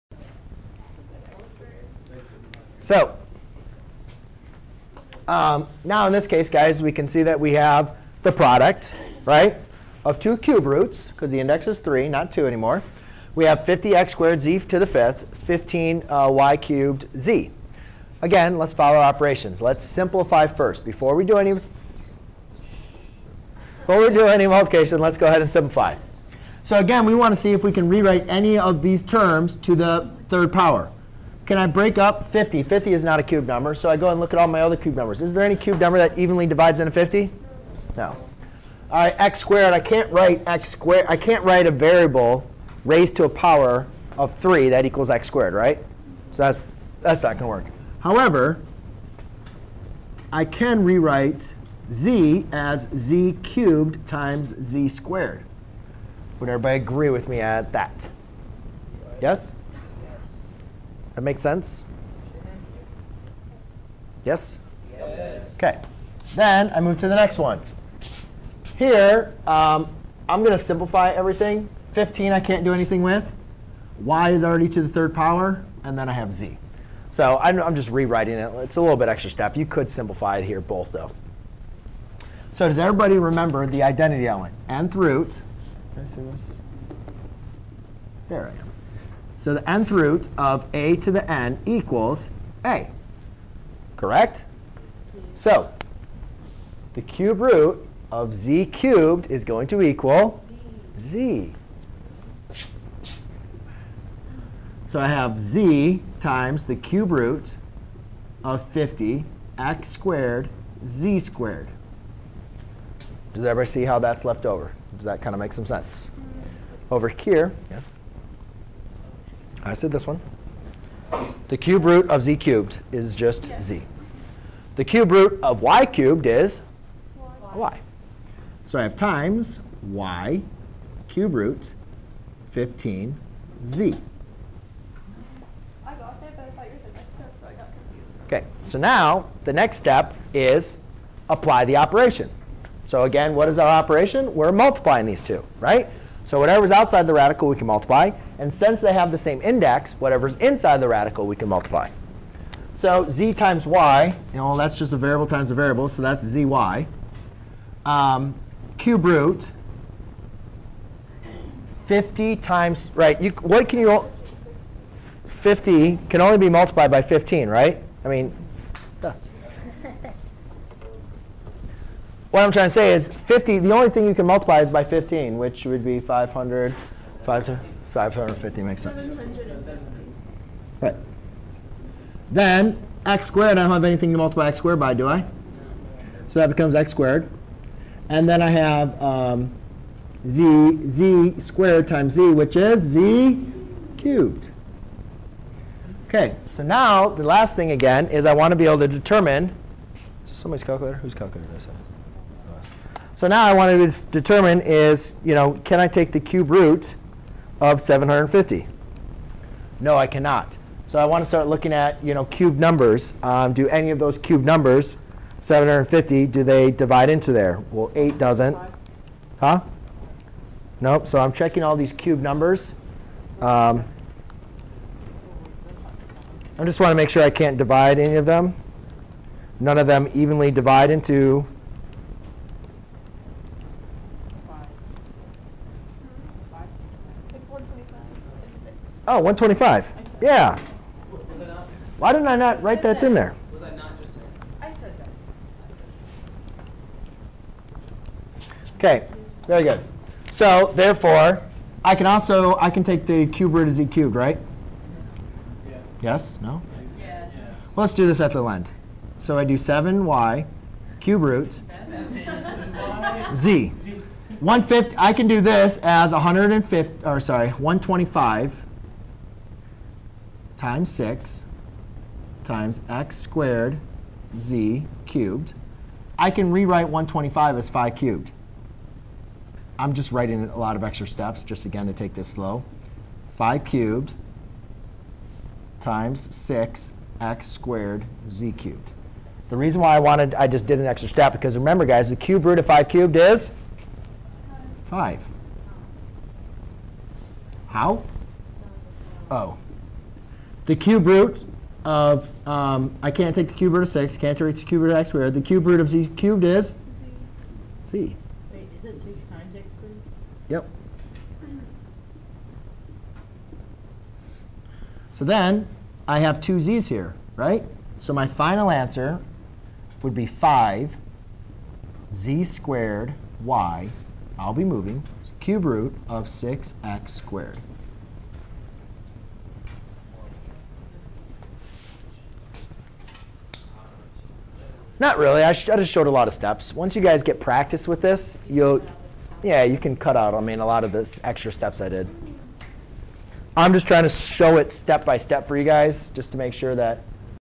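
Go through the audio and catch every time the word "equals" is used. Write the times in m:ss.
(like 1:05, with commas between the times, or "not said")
0:44, 1:31, 1:39.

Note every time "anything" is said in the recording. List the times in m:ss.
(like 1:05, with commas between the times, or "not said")
1:12, 3:03.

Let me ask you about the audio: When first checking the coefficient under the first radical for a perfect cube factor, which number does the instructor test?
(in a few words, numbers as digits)
50.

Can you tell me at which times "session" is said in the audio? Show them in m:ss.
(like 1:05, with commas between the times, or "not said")
not said.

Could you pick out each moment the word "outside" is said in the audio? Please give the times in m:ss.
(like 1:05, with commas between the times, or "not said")
2:26.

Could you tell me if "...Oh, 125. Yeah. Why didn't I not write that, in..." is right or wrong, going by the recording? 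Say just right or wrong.
right.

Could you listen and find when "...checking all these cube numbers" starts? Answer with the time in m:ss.
3:41.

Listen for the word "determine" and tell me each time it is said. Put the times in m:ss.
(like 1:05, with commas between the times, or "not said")
3:18, 3:24.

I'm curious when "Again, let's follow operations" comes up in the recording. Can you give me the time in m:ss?
0:18.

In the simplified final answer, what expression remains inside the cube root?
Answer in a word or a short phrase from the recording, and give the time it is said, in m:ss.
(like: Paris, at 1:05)
6x squared, at 5:25.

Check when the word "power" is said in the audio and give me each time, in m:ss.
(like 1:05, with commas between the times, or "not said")
0:30, 0:43, 1:15.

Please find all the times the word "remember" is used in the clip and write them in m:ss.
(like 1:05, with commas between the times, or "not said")
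1:23, 4:51.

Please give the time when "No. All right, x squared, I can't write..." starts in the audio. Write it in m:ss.
0:37.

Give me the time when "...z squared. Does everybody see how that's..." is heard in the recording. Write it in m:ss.
1:50.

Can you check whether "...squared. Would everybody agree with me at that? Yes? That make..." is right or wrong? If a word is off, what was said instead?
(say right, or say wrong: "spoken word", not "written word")
right.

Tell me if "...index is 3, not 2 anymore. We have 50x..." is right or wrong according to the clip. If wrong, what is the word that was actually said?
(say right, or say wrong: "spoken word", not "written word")
right.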